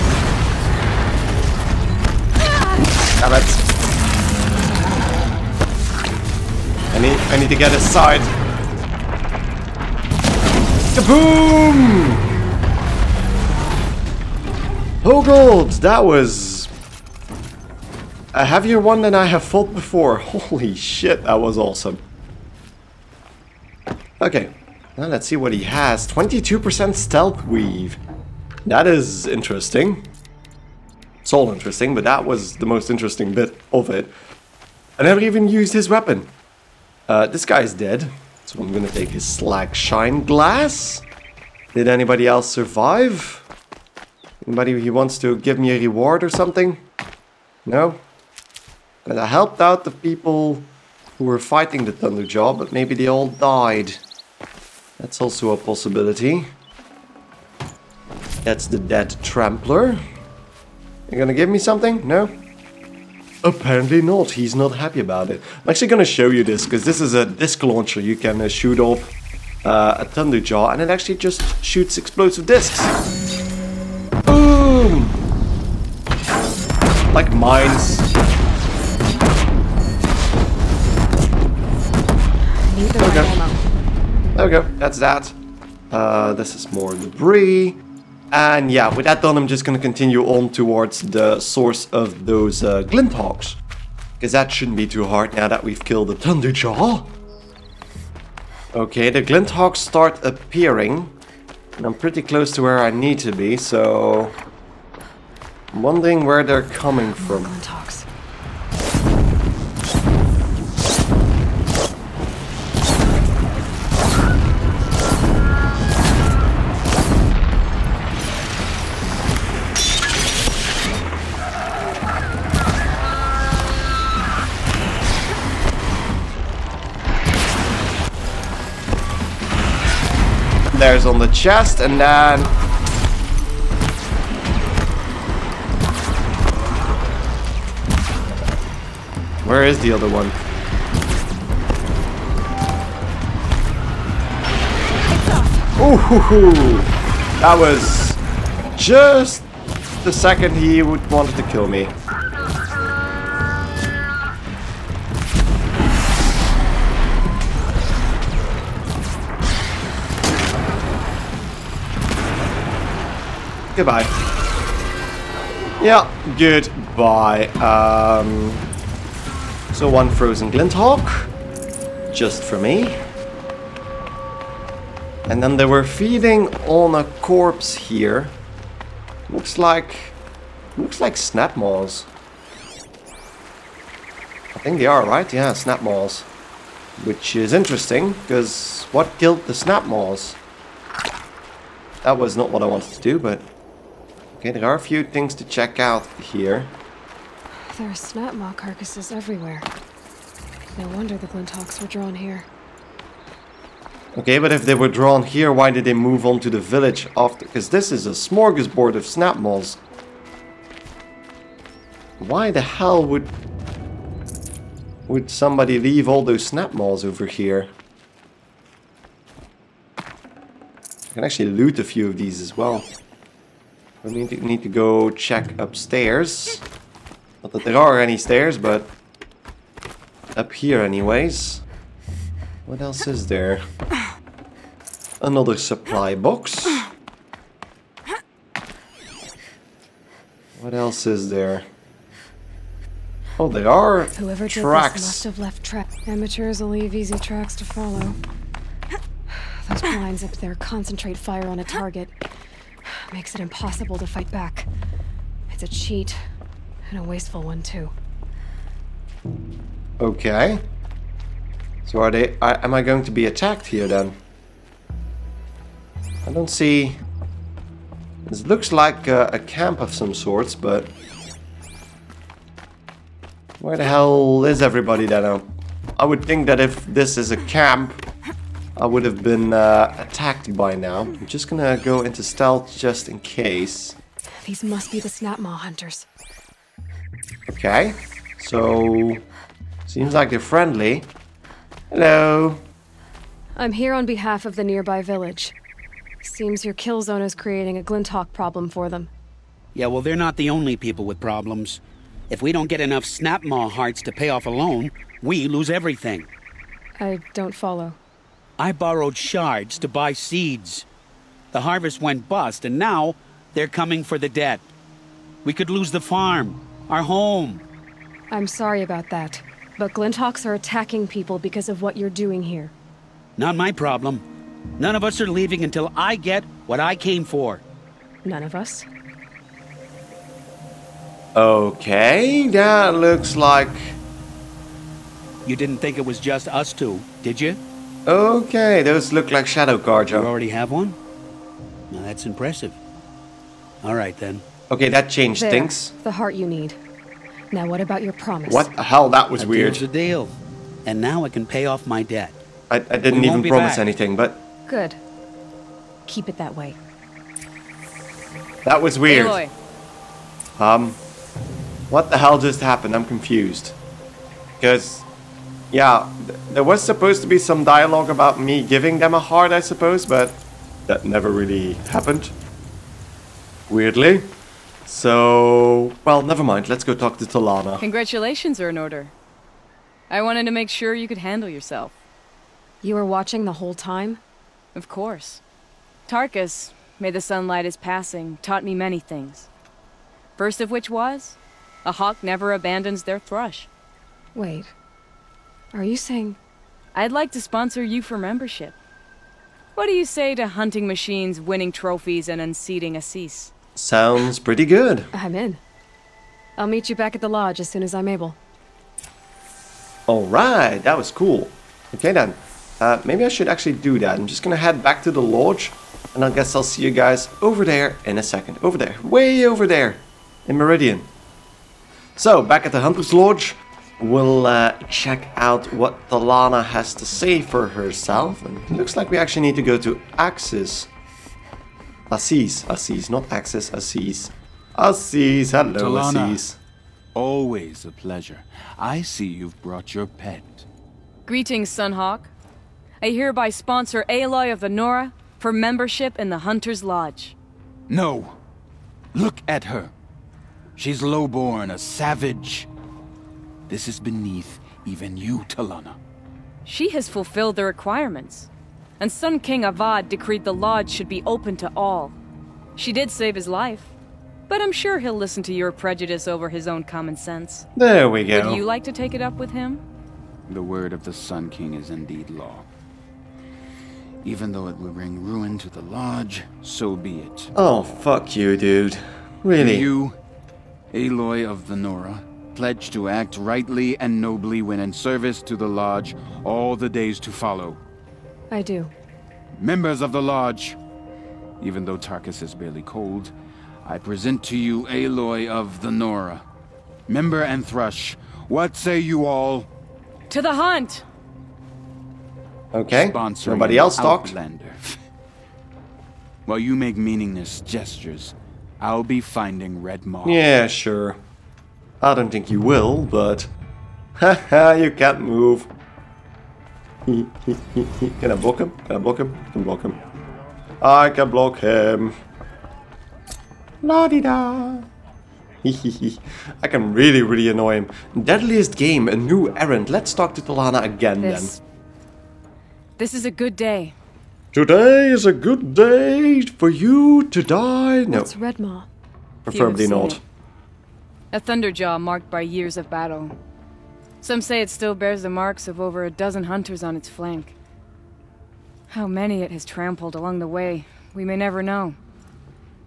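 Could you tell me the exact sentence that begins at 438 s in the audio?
I see you've brought your pet.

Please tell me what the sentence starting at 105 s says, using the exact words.
I'm wondering where they're coming from.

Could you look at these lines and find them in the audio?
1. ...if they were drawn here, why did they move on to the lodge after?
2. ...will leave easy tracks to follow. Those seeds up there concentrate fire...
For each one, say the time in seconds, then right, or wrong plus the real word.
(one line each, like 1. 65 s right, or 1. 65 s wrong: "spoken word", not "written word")
1. 204 s wrong: "village", not "lodge"
2. 246 s wrong: "blinds", not "seeds".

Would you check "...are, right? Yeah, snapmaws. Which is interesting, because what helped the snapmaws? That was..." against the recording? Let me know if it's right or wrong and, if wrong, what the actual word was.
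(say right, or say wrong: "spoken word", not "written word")
wrong: "killed", not "helped".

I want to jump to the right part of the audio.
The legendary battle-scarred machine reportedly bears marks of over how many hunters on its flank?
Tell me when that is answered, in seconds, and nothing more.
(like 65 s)
546 s.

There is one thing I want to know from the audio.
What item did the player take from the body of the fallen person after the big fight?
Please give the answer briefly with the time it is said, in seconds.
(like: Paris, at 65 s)
slag shine glass, at 39 s.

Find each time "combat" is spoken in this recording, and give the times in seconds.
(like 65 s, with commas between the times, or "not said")
not said.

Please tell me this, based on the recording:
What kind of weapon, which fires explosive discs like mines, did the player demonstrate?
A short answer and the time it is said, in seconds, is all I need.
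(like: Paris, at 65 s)
disc launcher, at 67 s.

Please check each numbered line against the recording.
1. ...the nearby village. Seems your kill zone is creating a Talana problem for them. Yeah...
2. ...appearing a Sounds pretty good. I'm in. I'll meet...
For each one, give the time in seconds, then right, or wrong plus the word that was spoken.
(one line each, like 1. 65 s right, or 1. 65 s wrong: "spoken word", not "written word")
1. 294 s wrong: "Glinthawk", not "Talana"
2. 402 s wrong: "unseating", not "appearing".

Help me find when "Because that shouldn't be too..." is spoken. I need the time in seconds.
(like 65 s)
94 s.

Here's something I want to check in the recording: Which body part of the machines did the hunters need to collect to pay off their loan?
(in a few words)
snapmaw hearts.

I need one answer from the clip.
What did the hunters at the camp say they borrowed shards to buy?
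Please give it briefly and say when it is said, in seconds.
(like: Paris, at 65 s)
seeds, at 310 s.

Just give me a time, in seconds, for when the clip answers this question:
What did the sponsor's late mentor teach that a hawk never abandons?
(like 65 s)
393 s.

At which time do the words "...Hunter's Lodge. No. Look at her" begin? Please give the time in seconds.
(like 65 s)
446 s.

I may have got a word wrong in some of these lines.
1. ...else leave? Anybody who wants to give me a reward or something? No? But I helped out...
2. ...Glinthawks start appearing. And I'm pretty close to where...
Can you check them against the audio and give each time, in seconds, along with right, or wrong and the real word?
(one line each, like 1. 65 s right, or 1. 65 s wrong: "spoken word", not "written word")
1. 42 s wrong: "survive", not "leave"
2. 99 s right.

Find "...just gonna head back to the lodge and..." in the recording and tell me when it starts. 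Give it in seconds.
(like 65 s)
414 s.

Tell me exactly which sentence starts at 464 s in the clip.
But I'm sure he'll listen to your prejudice over his own common sense.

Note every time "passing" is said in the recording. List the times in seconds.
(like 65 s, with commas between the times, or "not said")
387 s.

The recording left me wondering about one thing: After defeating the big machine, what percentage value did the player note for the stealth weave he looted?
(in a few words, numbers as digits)
22%.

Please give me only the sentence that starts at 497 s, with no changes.
Member and Thrush, what say you all?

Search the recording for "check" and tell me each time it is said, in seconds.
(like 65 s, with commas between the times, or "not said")
195 s, 225 s, 424 s.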